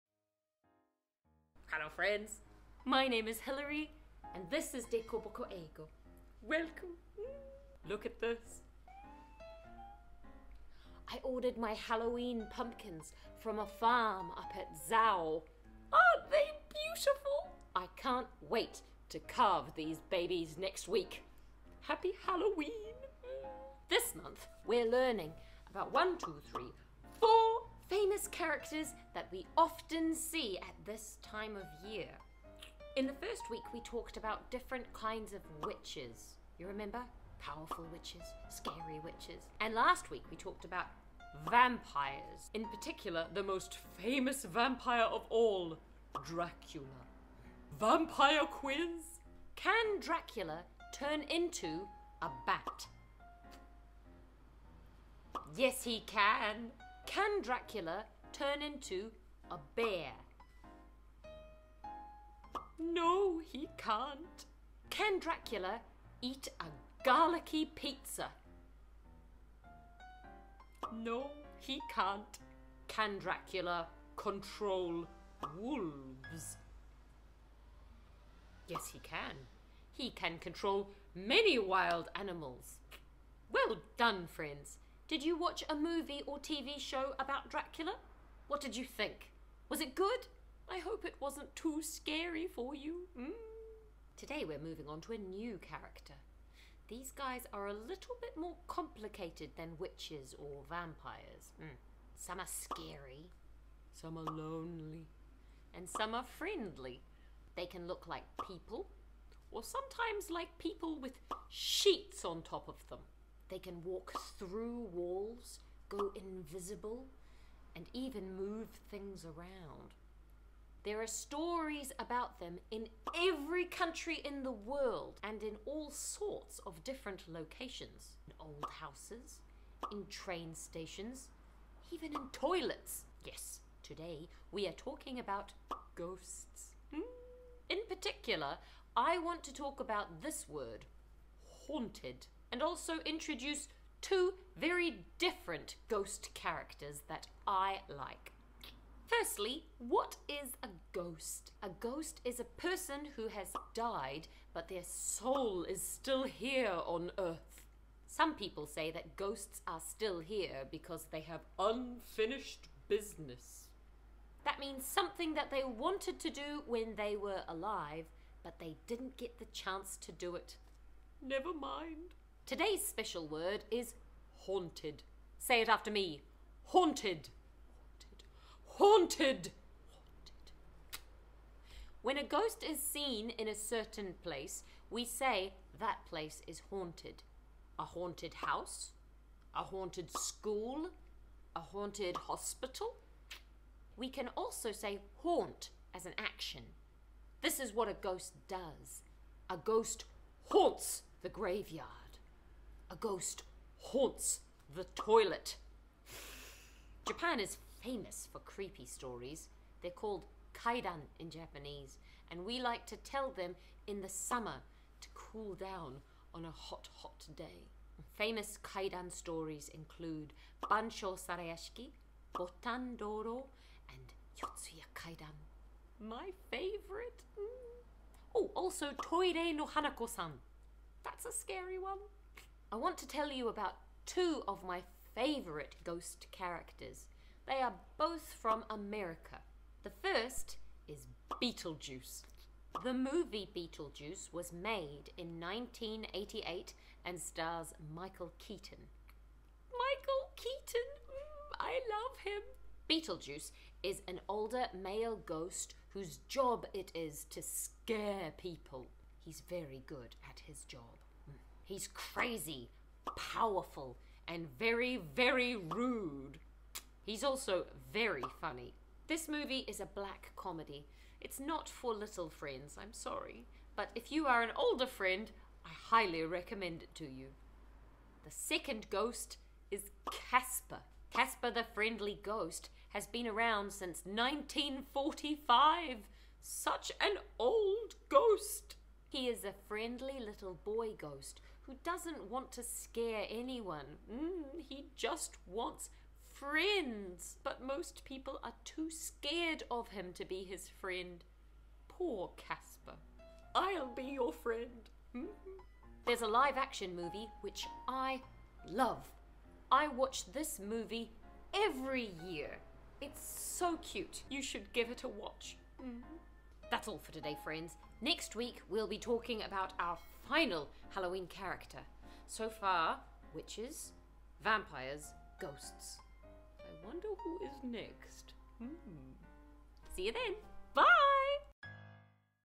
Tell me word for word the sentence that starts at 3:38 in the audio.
Famous kaidan stories include Bancho Sarayashiki, Botan Doro, and Yotsuya Kaidan.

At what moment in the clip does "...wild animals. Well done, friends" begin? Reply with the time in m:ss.
1:21.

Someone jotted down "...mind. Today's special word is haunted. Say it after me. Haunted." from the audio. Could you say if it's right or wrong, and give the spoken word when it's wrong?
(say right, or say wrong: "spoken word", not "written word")
right.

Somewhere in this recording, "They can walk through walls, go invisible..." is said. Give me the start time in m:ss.
1:53.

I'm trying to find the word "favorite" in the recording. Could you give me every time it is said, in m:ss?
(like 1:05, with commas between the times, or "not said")
3:46, 3:55.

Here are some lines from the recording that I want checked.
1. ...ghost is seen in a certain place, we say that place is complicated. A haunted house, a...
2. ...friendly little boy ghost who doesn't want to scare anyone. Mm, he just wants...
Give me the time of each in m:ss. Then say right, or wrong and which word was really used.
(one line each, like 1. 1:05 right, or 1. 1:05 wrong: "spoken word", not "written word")
1. 3:02 wrong: "haunted", not "complicated"
2. 4:49 right.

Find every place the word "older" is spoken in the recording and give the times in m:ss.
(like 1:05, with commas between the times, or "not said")
4:14, 4:34.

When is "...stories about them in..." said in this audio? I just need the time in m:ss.
2:01.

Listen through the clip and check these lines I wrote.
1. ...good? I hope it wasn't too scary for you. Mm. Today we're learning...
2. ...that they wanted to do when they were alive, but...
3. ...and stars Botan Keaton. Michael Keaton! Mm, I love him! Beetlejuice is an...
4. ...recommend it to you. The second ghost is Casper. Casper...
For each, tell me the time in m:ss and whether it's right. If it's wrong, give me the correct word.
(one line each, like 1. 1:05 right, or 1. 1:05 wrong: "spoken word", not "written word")
1. 1:29 wrong: "moving", not "learning"
2. 2:45 right
3. 4:07 wrong: "Michael", not "Botan"
4. 4:36 right.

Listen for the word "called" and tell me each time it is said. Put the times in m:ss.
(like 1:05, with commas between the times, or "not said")
3:29.